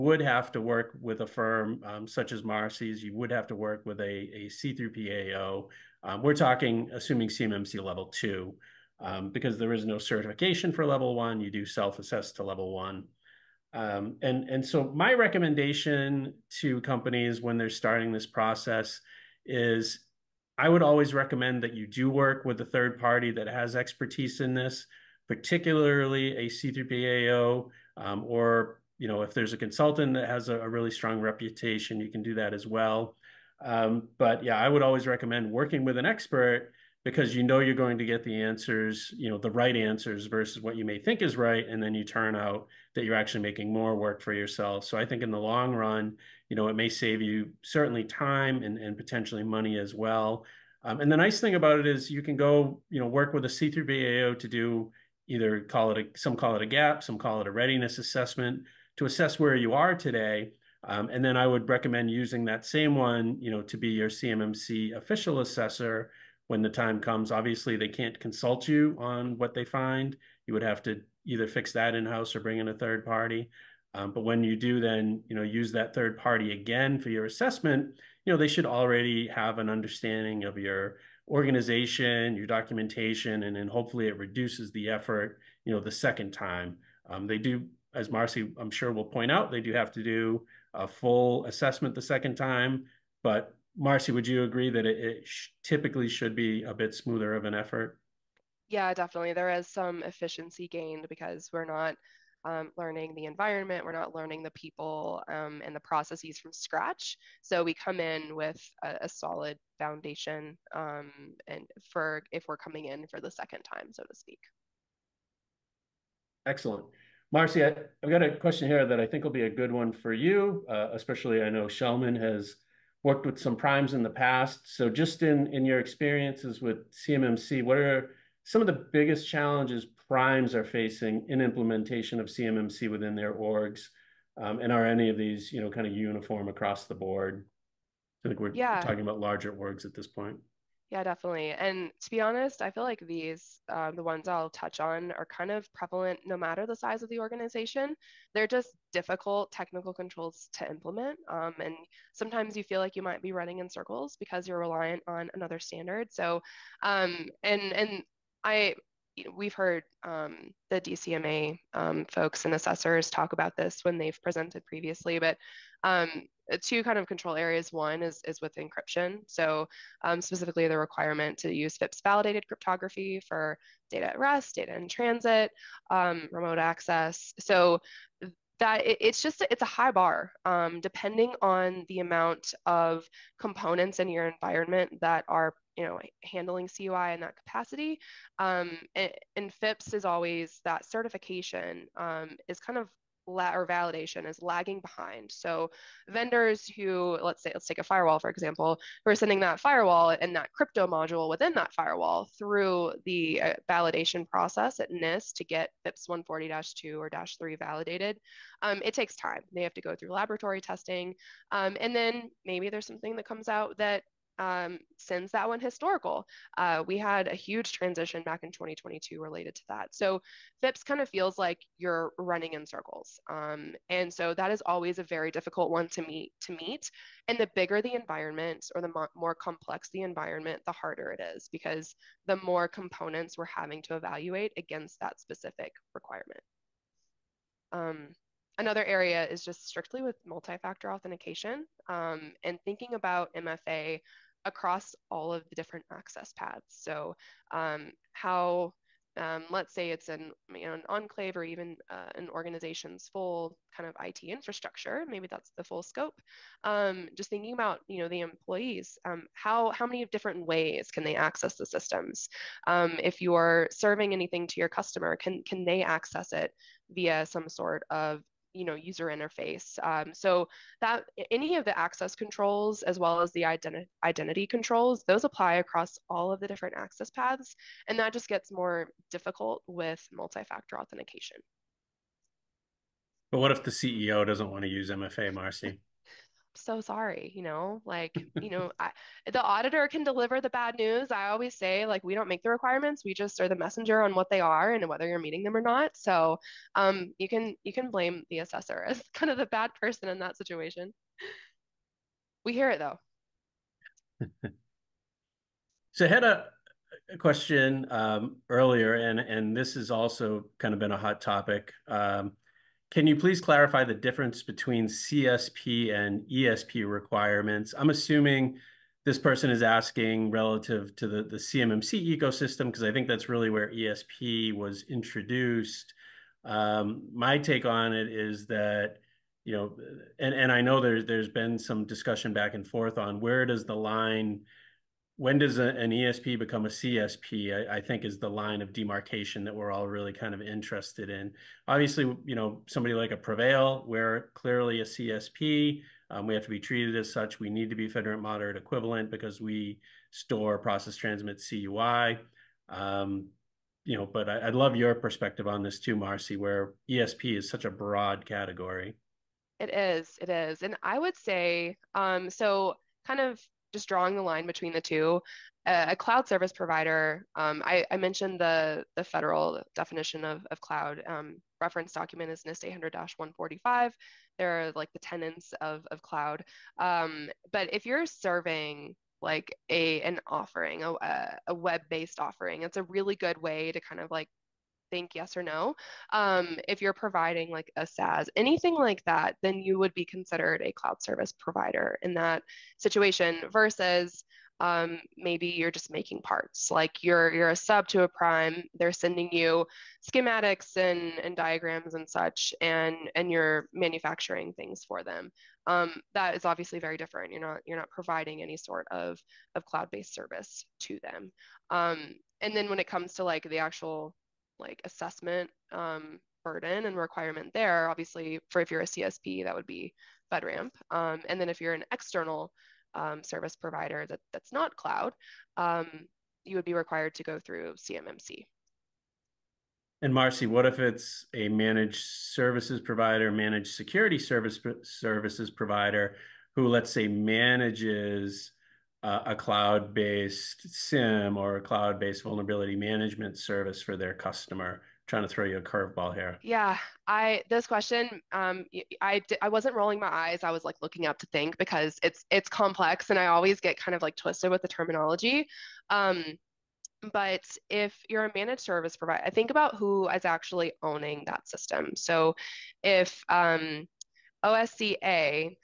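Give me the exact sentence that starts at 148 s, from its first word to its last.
They're just difficult technical controls to implement.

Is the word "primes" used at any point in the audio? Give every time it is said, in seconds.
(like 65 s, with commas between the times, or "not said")
123 s, 130 s, 398 s.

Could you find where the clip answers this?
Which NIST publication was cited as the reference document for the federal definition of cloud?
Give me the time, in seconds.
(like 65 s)
372 s.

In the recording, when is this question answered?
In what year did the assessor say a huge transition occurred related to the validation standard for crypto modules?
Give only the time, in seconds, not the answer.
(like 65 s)
218 s.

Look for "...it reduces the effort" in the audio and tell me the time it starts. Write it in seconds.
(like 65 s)
84 s.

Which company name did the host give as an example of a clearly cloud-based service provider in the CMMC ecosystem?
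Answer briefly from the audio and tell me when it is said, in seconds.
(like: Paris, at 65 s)
PreVeil, at 343 s.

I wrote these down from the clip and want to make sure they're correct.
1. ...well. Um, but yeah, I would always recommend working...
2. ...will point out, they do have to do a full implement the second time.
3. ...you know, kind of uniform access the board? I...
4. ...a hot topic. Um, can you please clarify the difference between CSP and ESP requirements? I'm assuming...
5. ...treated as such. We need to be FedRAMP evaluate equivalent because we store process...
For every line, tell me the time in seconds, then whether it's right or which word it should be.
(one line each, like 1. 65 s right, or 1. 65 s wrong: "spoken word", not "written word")
1. 32 s right
2. 88 s wrong: "assessment", not "implement"
3. 135 s wrong: "across", not "access"
4. 310 s right
5. 346 s wrong: "moderate", not "evaluate".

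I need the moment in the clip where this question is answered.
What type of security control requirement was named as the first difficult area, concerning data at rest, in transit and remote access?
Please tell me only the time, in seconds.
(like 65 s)
171 s.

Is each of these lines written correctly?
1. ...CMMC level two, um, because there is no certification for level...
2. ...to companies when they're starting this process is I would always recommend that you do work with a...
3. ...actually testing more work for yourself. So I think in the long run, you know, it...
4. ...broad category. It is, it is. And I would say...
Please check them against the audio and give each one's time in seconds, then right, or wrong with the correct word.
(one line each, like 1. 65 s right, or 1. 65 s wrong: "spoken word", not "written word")
1. 7 s right
2. 16 s right
3. 43 s wrong: "making", not "testing"
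4. 357 s right.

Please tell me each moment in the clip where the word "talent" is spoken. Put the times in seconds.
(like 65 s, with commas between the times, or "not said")
not said.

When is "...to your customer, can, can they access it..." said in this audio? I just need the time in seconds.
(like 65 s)
264 s.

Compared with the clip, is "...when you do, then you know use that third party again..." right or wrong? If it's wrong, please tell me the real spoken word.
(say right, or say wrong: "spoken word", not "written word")
right.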